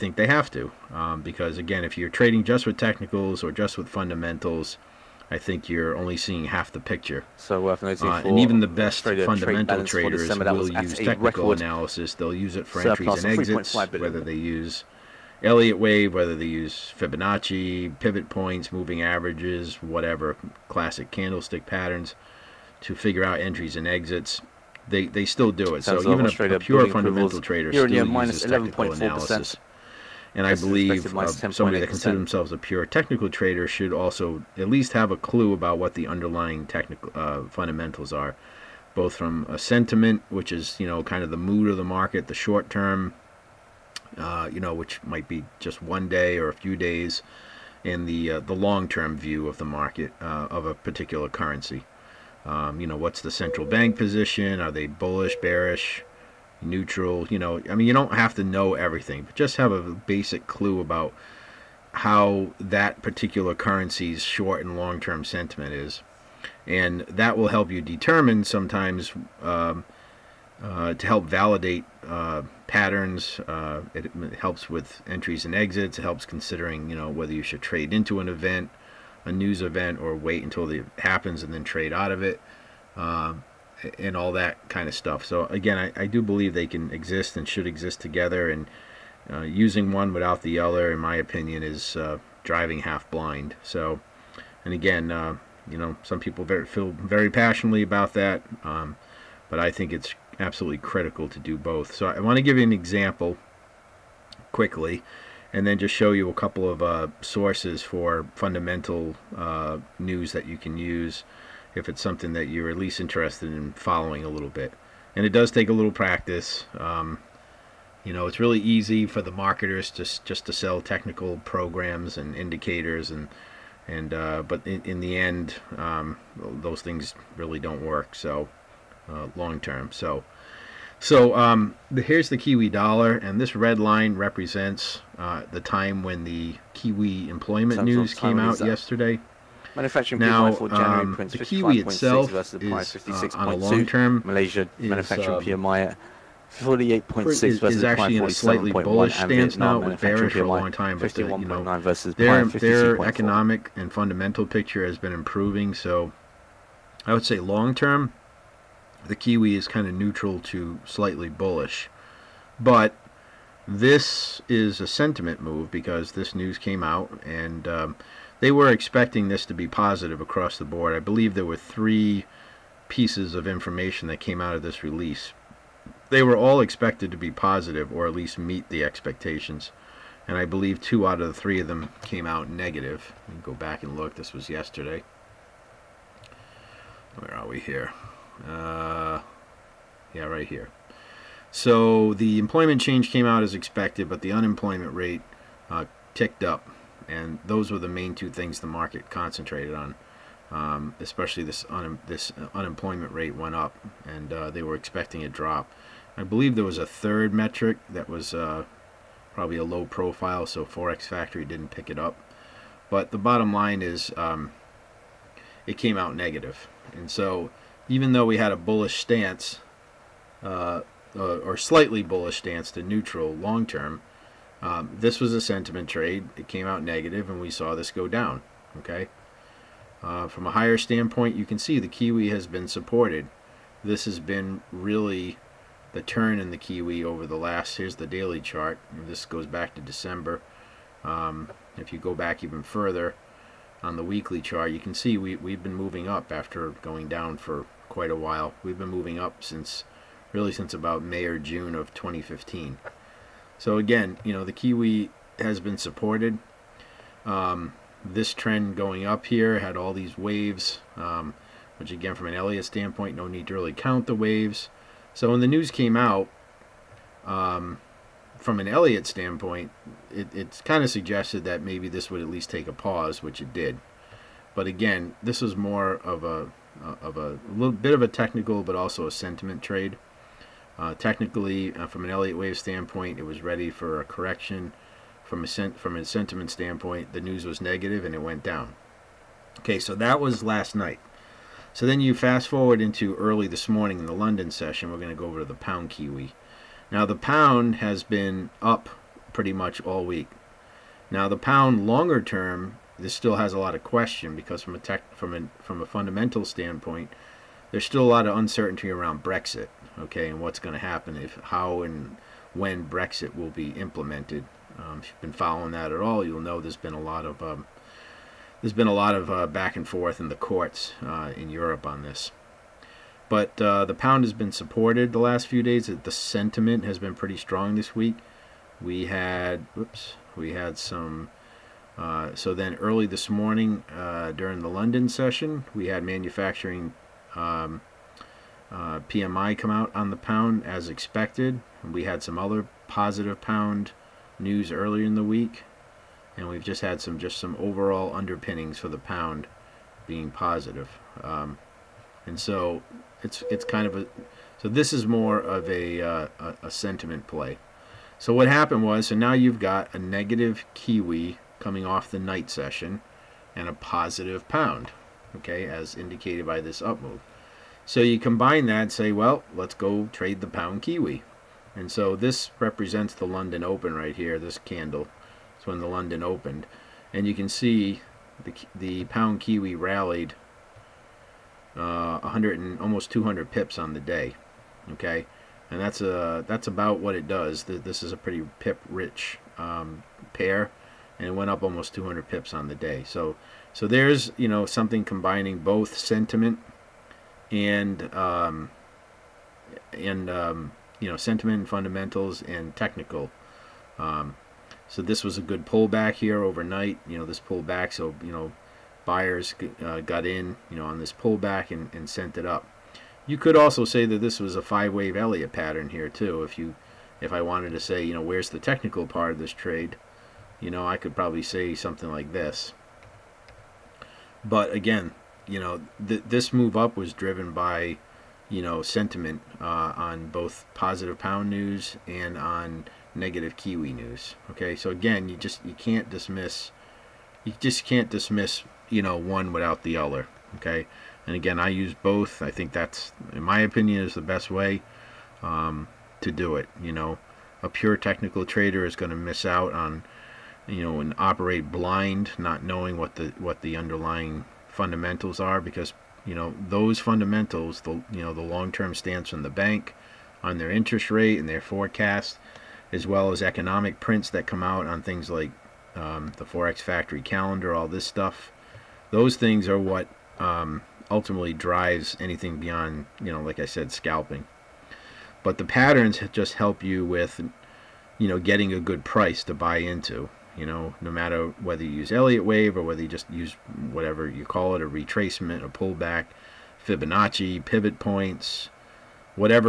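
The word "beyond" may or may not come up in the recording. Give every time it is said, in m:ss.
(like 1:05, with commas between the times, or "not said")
7:52.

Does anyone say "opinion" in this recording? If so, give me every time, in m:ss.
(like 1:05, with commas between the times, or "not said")
1:31, 7:23.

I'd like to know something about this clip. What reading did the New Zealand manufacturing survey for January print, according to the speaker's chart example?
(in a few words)
56.2.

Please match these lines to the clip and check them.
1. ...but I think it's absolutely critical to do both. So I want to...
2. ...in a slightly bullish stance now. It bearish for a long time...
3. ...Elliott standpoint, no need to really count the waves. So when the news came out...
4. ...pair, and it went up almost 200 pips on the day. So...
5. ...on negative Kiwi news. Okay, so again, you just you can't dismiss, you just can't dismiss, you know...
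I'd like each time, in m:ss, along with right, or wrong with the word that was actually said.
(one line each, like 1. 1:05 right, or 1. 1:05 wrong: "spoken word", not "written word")
1. 1:39 right
2. 2:28 right
3. 4:22 right
4. 6:30 right
5. 7:12 right.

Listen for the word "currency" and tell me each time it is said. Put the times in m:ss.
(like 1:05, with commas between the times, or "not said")
0:51, 1:03.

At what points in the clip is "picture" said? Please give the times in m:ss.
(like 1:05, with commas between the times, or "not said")
0:06, 2:34.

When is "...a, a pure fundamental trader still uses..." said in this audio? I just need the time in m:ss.
0:26.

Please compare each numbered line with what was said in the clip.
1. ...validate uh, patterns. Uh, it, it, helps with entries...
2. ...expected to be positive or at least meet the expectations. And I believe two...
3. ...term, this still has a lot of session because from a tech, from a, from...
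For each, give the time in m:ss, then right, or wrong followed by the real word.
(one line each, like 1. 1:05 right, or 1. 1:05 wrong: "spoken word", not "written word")
1. 1:11 right
2. 2:56 right
3. 5:02 wrong: "question", not "session".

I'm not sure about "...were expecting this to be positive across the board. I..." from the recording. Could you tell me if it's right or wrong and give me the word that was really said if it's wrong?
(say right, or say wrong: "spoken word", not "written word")
right.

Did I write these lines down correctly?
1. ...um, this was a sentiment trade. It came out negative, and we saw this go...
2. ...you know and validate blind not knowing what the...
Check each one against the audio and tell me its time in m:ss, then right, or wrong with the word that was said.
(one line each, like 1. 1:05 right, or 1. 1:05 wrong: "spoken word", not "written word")
1. 3:44 right
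2. 7:30 wrong: "operate", not "validate".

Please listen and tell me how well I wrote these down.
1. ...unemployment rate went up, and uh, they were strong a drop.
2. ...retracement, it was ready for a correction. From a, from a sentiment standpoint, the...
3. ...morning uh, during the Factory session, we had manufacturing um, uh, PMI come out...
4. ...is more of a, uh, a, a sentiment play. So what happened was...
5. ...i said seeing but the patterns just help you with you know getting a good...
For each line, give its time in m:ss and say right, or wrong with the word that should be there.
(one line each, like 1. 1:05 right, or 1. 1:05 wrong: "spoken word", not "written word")
1. 3:22 wrong: "expecting", not "strong"
2. 4:42 wrong: "standpoint", not "retracement"
3. 5:33 wrong: "London", not "Factory"
4. 5:54 right
5. 7:53 wrong: "scalping", not "seeing".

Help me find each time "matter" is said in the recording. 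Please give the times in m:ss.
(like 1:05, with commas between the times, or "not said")
8:01.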